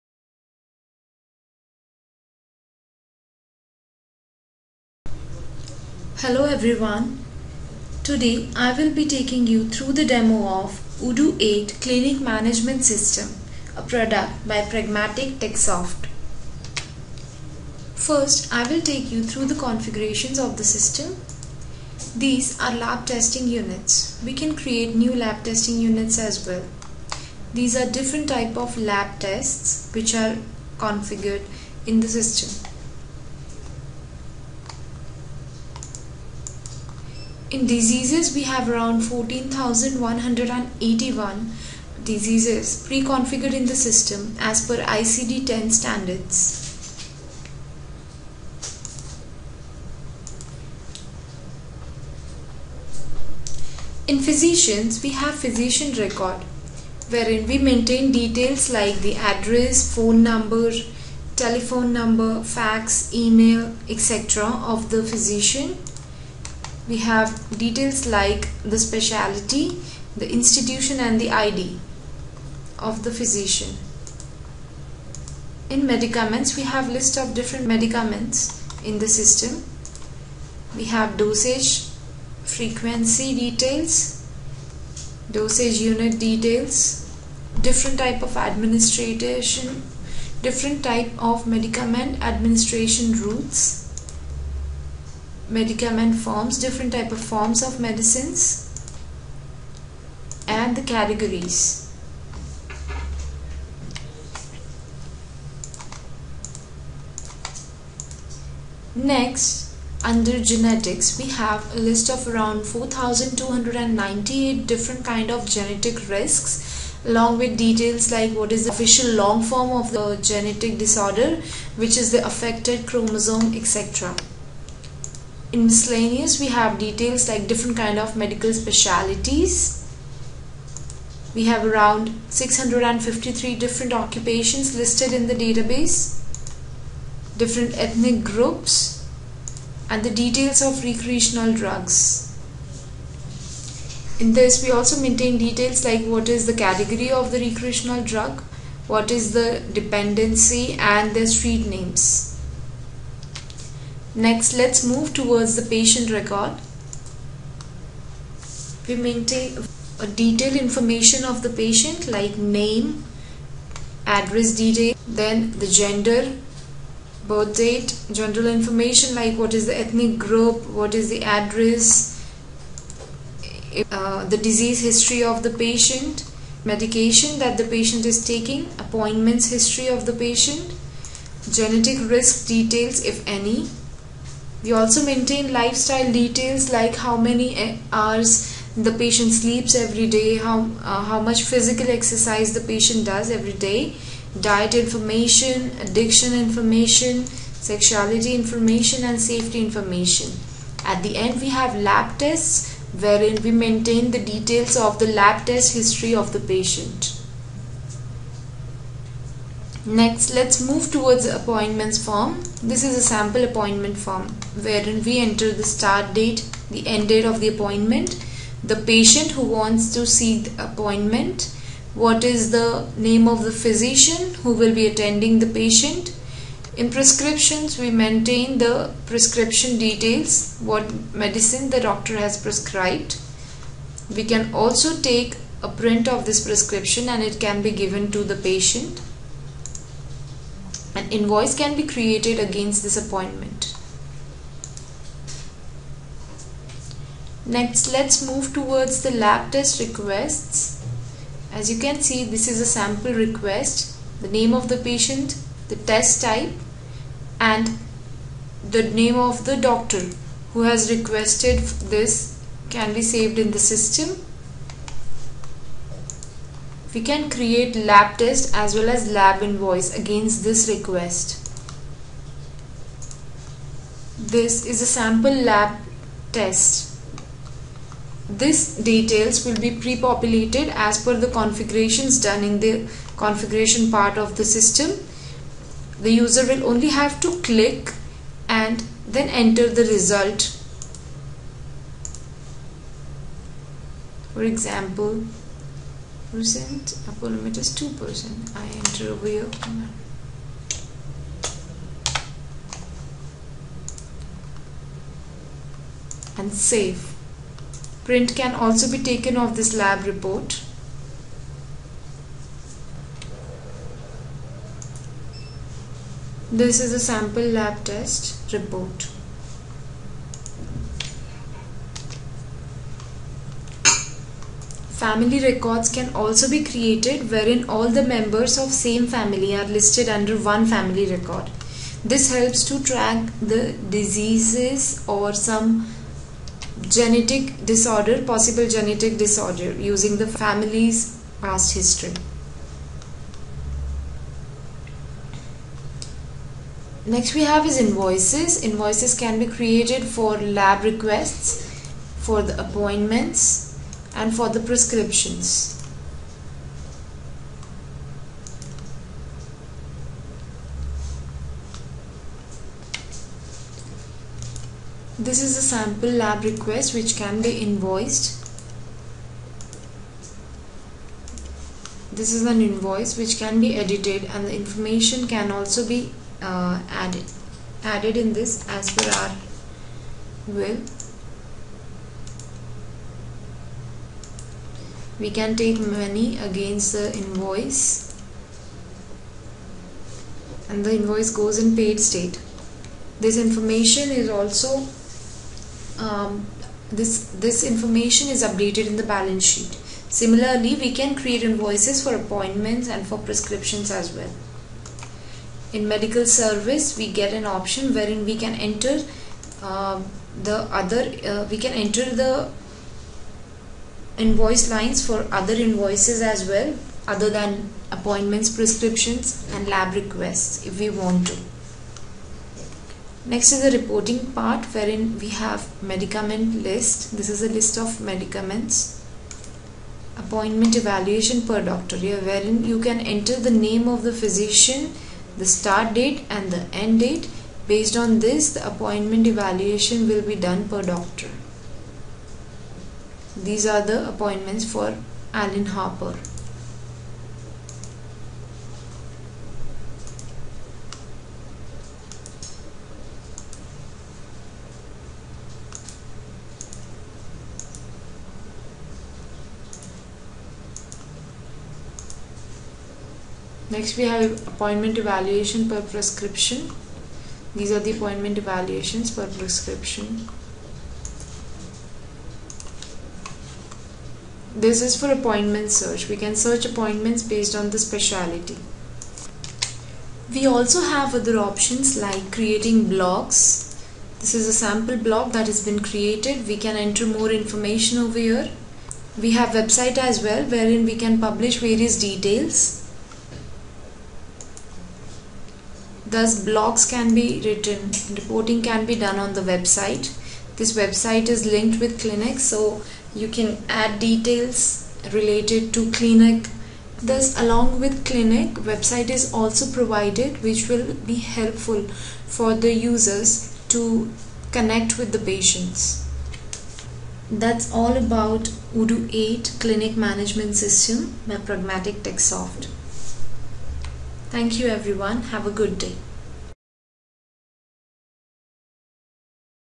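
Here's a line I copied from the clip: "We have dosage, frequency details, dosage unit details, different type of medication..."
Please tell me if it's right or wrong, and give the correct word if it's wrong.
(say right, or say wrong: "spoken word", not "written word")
wrong: "administration", not "medication".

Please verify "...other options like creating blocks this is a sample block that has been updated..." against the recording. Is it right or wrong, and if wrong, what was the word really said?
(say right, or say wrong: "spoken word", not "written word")
wrong: "created", not "updated".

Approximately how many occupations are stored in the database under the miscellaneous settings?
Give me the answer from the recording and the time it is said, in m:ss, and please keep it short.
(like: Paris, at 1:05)
653, at 2:12.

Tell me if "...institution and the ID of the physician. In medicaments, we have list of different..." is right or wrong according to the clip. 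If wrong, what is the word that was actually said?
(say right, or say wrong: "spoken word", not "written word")
right.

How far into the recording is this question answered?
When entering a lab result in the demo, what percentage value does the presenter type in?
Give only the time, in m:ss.
4:57.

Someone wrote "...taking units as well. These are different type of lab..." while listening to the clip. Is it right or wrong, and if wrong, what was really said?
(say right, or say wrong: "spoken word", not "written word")
wrong: "testing", not "taking".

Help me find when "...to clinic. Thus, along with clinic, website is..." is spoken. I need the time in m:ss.
8:25.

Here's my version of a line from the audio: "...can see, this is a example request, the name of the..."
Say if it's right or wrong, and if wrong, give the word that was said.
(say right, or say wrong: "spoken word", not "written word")
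wrong: "sample", not "example".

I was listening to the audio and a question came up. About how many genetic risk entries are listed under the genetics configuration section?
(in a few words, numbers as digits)
4,298.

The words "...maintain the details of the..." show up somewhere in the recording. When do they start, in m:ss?
3:23.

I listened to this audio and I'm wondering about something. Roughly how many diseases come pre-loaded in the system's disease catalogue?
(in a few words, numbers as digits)
14,181.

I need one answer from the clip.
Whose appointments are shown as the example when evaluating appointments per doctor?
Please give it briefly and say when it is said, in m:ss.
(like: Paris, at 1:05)
Alan Harper, at 7:25.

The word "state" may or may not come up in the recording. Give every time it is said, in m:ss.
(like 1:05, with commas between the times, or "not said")
6:32.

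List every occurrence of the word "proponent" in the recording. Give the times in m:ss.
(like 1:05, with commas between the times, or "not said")
not said.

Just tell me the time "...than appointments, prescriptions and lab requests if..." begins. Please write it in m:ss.
6:57.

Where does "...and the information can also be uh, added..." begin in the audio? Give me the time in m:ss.
6:14.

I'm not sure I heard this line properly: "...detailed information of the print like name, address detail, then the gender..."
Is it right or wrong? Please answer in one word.
wrong.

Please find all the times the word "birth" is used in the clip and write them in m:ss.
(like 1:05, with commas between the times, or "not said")
2:47.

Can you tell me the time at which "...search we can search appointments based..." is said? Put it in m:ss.
7:55.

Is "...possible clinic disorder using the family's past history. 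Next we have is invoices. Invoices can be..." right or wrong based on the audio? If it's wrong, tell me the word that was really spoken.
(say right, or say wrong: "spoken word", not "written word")
wrong: "genetic", not "clinic".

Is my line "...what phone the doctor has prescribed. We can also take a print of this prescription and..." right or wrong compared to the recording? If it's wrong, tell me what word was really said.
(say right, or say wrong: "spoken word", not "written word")
wrong: "medicine", not "phone".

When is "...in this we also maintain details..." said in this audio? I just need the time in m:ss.
2:24.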